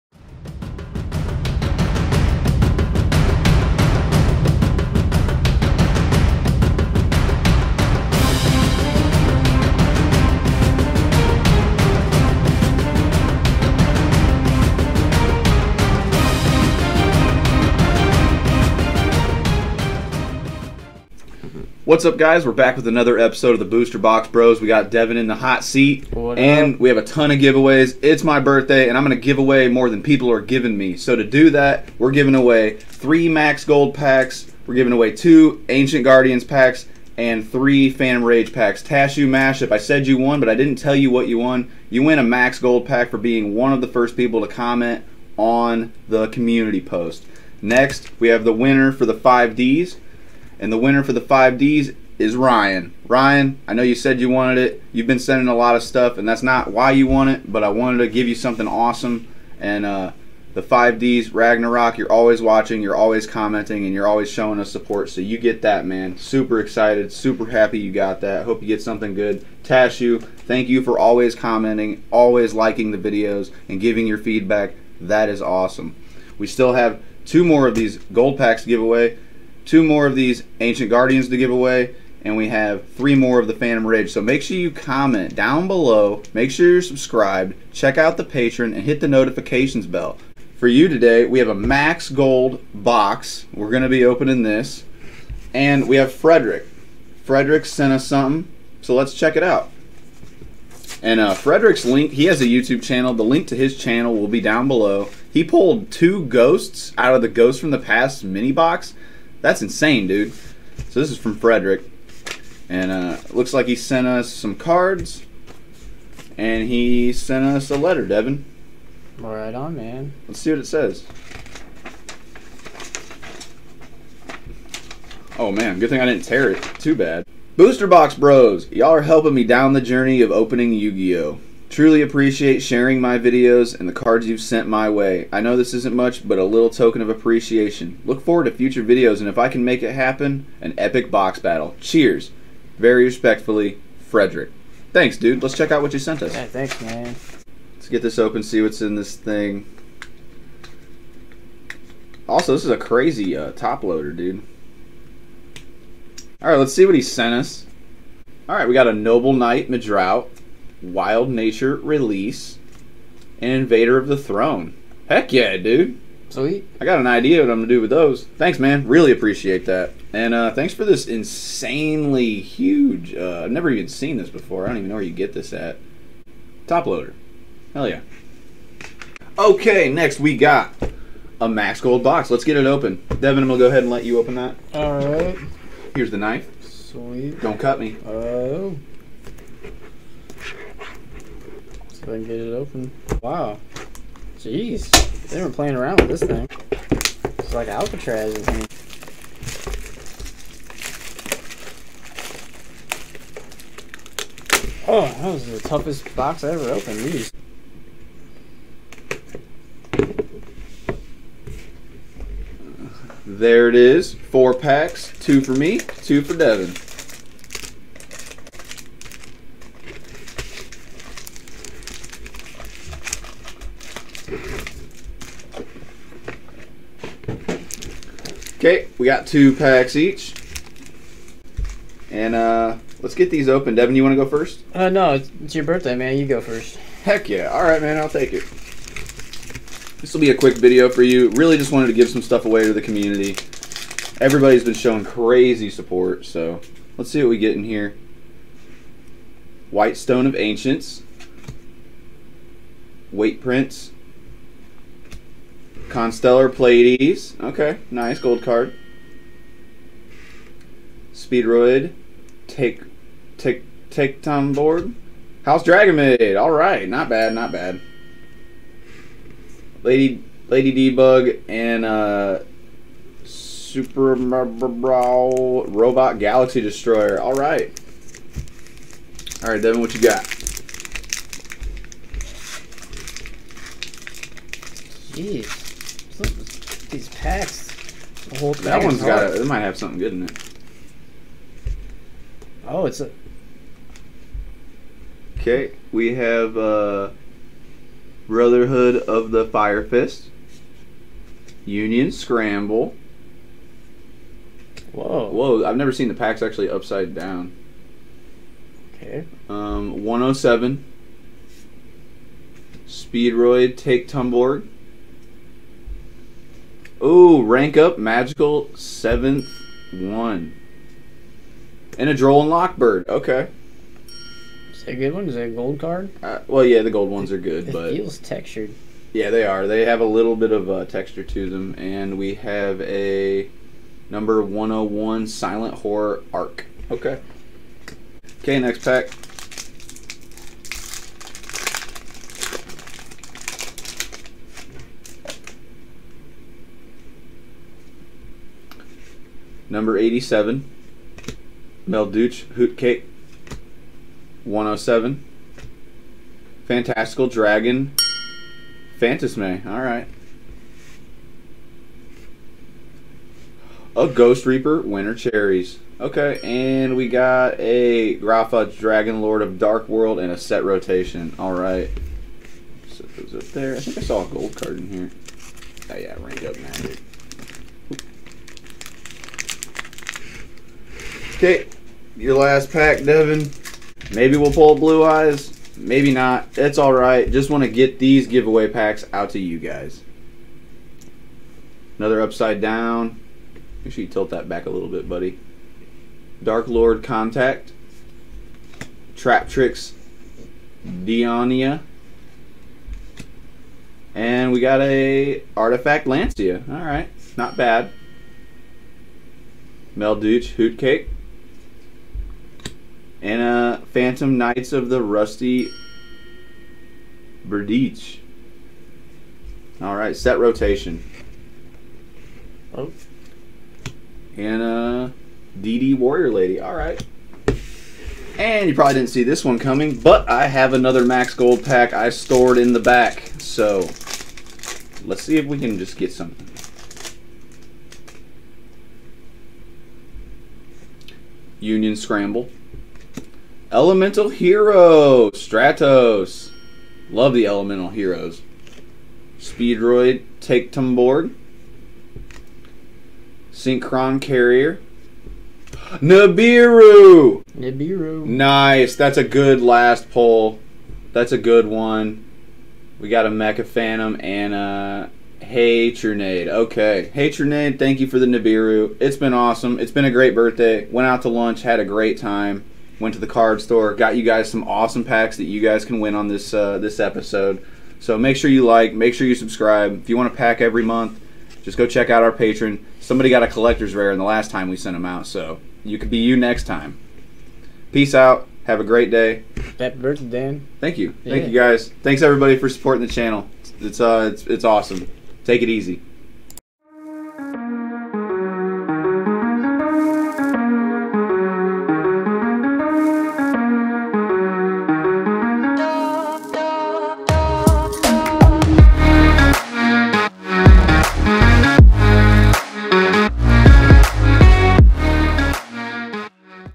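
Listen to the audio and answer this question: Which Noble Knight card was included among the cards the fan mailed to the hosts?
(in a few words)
Noble Knight Medraut.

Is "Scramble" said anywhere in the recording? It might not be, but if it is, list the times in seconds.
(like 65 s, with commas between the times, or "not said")
302 s, 441 s.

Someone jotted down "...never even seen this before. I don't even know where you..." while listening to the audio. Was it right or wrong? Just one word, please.
right.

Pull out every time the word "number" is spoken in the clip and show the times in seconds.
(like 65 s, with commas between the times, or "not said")
334 s, 349 s.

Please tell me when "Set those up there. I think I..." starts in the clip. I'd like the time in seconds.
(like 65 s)
372 s.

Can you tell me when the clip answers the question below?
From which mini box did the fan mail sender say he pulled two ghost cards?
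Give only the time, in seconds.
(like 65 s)
107 s.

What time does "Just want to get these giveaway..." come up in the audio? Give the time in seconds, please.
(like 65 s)
387 s.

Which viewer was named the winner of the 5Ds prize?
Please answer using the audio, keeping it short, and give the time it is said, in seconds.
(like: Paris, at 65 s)
Ryan, at 52 s.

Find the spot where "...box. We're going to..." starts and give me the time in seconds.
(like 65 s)
92 s.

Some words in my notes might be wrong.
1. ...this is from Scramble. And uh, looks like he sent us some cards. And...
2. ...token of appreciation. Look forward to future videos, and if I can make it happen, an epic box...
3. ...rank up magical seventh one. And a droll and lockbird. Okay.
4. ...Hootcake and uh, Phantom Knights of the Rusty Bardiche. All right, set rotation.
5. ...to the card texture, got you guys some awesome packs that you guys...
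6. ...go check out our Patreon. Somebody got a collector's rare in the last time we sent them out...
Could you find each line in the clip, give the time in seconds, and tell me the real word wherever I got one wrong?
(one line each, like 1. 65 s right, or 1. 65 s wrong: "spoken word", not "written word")
1. 110 s wrong: "Frederick", not "Scramble"
2. 136 s right
3. 317 s right
4. 410 s right
5. 473 s wrong: "store", not "texture"
6. 481 s right.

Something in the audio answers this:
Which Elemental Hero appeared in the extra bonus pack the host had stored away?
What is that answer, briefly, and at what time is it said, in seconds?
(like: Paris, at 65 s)
Stratos, at 445 s.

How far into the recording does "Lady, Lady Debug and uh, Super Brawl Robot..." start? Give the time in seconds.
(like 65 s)
269 s.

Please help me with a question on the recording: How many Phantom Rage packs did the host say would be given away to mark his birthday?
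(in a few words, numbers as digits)
3.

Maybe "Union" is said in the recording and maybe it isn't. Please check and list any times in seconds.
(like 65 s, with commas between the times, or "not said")
301 s, 441 s.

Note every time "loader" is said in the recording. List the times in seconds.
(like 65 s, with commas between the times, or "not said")
153 s, 176 s.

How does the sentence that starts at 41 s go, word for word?
You win a Max Gold pack for being one of the first people to comment on the community post.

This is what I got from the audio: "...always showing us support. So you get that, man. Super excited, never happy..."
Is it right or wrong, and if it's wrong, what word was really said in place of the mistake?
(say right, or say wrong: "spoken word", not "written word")
wrong: "super", not "never".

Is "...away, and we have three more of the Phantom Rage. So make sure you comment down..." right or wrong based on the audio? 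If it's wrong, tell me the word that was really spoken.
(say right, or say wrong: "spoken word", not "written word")
right.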